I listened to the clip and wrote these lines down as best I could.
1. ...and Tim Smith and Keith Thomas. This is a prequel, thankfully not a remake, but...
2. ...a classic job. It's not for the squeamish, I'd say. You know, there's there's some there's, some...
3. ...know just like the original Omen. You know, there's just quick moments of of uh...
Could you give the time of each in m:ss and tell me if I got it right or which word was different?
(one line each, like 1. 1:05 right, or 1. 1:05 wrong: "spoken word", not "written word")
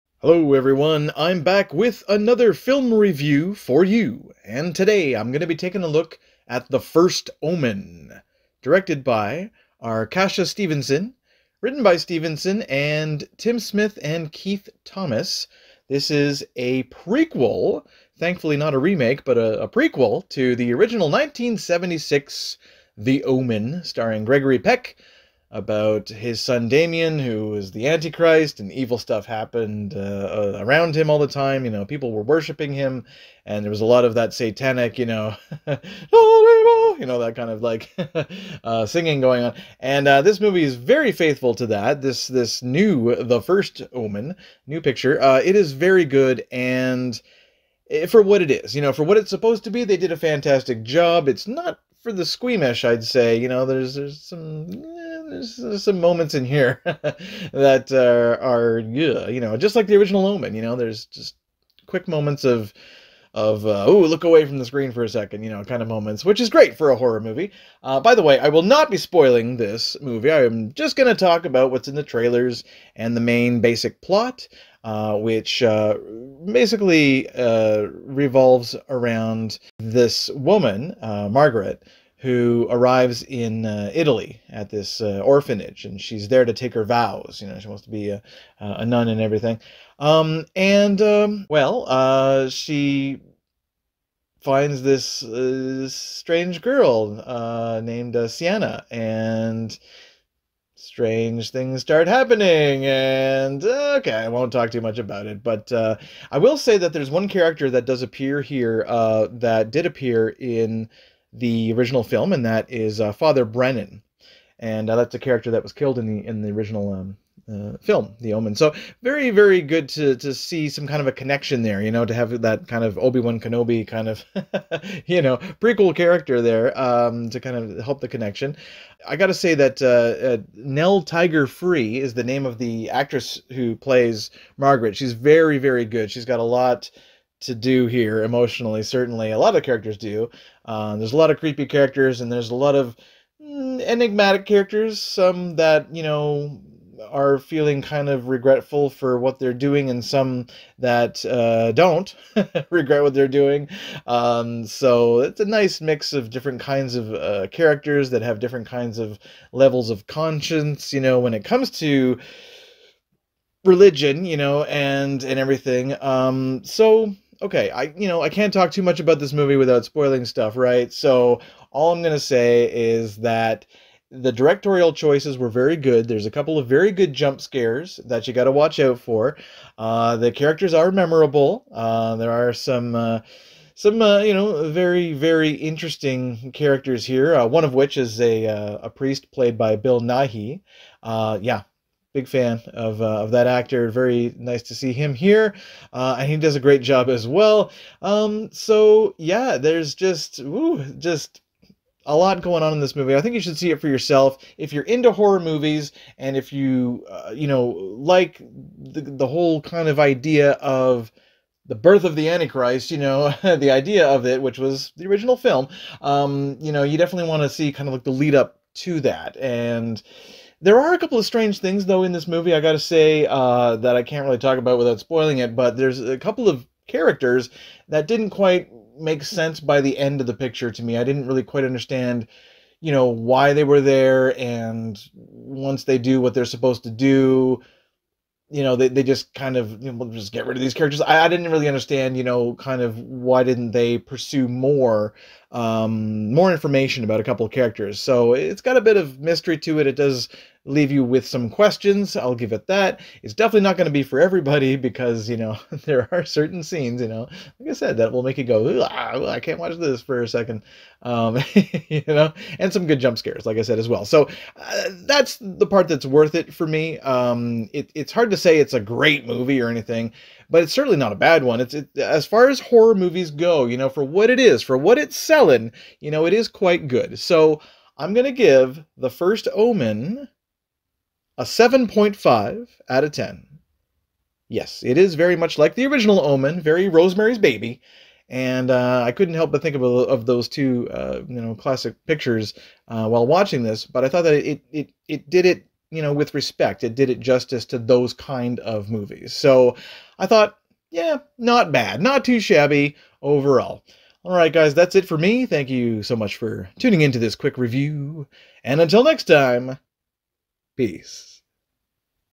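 1. 0:12 right
2. 0:50 wrong: "fantastic", not "classic"
3. 0:59 right.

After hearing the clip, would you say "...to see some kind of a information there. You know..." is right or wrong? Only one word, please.
wrong.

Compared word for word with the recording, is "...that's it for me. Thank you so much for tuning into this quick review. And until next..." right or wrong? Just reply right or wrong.
right.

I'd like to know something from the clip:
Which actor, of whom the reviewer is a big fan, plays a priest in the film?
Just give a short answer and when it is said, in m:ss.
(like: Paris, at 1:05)
Bill Nighy, at 3:09.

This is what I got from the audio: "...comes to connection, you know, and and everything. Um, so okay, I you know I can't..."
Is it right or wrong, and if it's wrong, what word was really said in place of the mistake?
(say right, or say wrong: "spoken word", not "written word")
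wrong: "religion", not "connection".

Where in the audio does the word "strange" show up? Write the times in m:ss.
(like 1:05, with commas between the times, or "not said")
1:35, 1:40, 3:41.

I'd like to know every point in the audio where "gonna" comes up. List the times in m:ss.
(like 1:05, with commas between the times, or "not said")
2:52, 4:38.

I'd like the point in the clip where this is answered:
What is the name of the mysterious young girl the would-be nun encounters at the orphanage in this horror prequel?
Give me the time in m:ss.
1:38.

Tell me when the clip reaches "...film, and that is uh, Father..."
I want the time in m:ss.
1:52.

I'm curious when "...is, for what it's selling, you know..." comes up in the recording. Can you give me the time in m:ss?
4:34.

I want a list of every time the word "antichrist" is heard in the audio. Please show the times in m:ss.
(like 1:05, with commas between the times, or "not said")
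0:27, 3:32.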